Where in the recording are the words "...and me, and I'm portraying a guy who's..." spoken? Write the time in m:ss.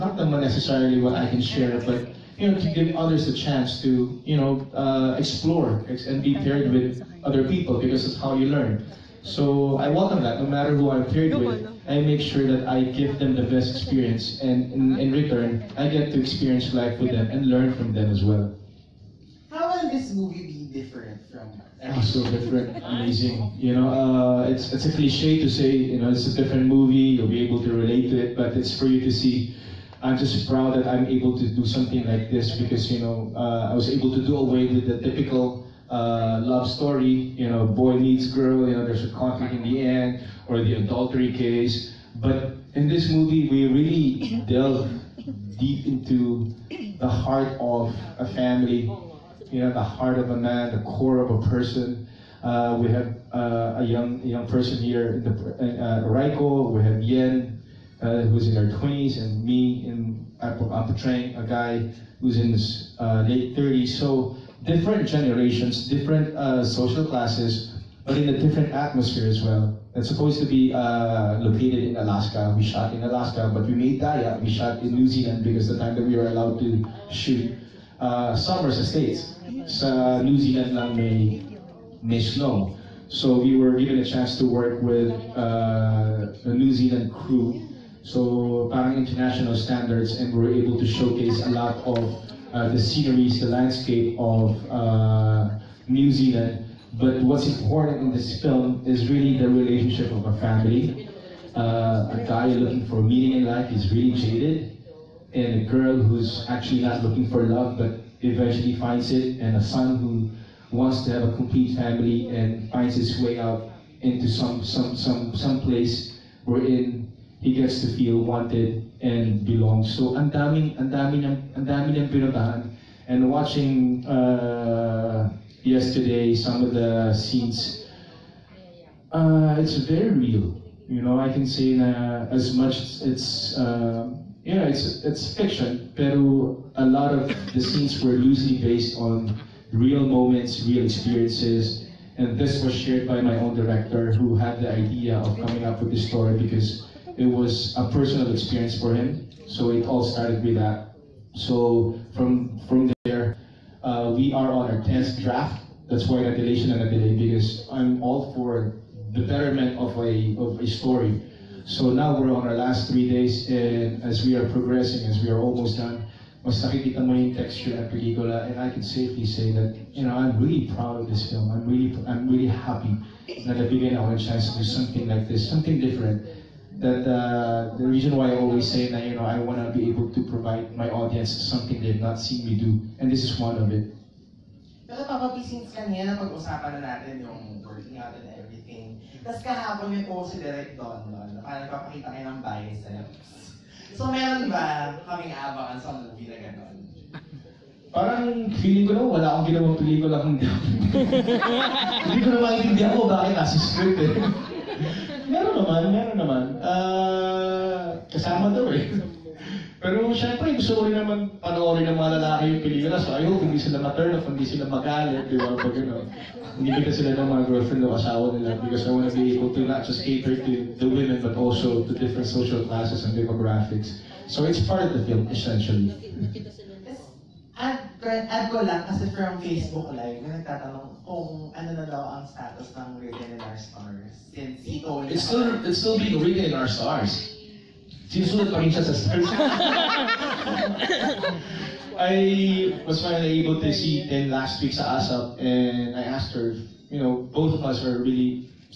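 0:59.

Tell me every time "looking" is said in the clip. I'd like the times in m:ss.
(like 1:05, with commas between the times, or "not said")
1:42, 1:47.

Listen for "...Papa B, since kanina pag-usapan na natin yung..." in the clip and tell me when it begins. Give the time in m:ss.
3:05.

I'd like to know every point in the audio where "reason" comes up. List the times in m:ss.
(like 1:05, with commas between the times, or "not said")
2:57.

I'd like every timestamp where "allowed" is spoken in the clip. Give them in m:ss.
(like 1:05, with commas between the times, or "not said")
1:16.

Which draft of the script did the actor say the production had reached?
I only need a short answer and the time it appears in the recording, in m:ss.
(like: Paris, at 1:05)
tenth draft, at 2:34.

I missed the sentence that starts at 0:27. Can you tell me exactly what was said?
You'll be able to relate to it, but it's for you to see.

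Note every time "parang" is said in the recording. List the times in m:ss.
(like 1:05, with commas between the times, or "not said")
1:28, 3:11, 3:17.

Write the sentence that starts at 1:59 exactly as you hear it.
So ang daming ang dami niyang ang dami niyang pinuntahan and watching uh, yesterday some of the scenes uh, it's very real.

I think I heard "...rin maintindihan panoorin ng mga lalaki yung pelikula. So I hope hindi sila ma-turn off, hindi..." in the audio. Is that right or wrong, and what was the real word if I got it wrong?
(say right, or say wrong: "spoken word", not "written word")
wrong: "naman", not "maintindihan".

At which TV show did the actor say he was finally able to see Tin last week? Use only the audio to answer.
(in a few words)
ASAP.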